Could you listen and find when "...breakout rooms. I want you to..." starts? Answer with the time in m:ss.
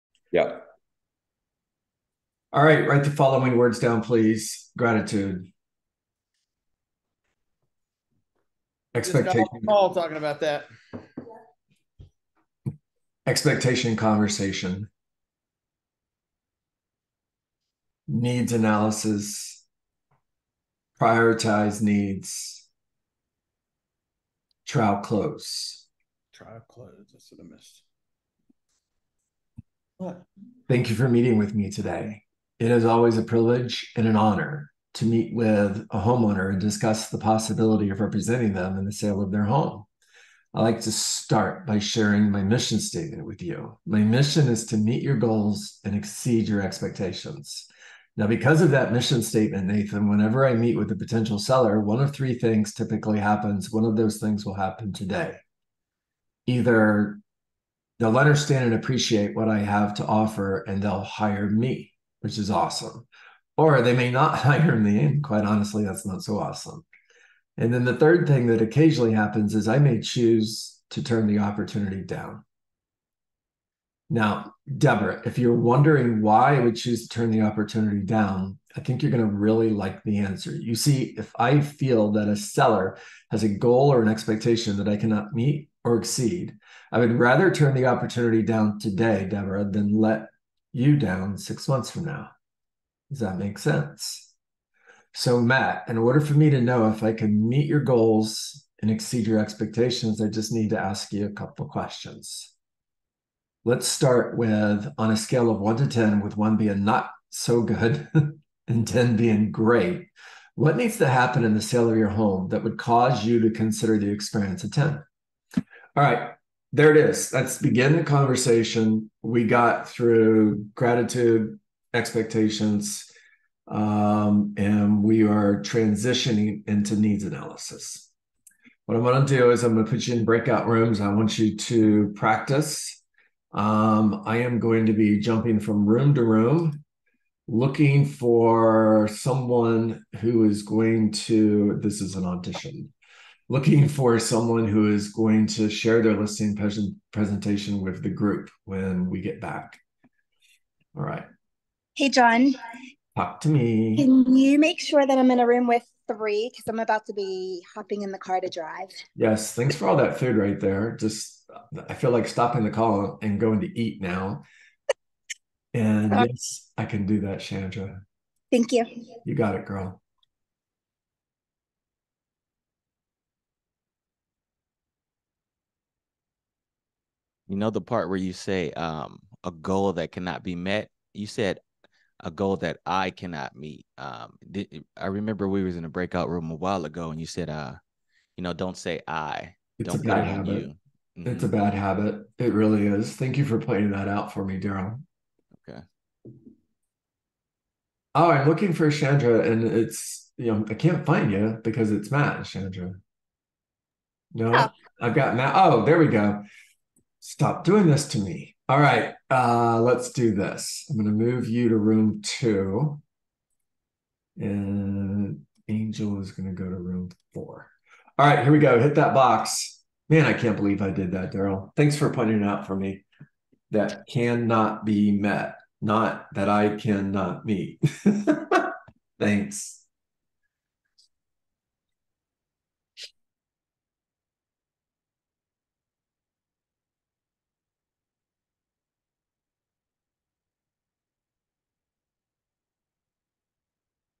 2:10.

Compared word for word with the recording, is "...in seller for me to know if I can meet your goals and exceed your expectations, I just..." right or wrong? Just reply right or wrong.
wrong.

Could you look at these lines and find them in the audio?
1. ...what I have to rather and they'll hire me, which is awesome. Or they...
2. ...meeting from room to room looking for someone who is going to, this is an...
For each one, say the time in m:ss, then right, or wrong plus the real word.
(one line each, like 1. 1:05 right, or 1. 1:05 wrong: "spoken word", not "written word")
1. 0:59 wrong: "offer", not "rather"
2. 2:15 wrong: "jumping", not "meeting".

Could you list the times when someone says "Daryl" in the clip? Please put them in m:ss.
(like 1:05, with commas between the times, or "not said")
3:14, 3:41.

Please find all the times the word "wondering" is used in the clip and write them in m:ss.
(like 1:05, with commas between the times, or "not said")
1:15.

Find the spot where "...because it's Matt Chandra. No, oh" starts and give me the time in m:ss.
3:21.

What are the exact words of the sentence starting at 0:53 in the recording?
One of those things will happen today.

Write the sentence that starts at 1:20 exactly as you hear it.
You see, if I feel that a seller has a goal or an expectation that I cannot meet, or exceed.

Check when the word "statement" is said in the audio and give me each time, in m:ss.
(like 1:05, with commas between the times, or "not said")
0:42, 0:49.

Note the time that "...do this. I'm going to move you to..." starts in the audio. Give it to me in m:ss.
3:30.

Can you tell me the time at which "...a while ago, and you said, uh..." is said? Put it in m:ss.
3:06.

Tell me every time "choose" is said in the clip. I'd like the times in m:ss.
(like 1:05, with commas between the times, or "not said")
1:10, 1:16.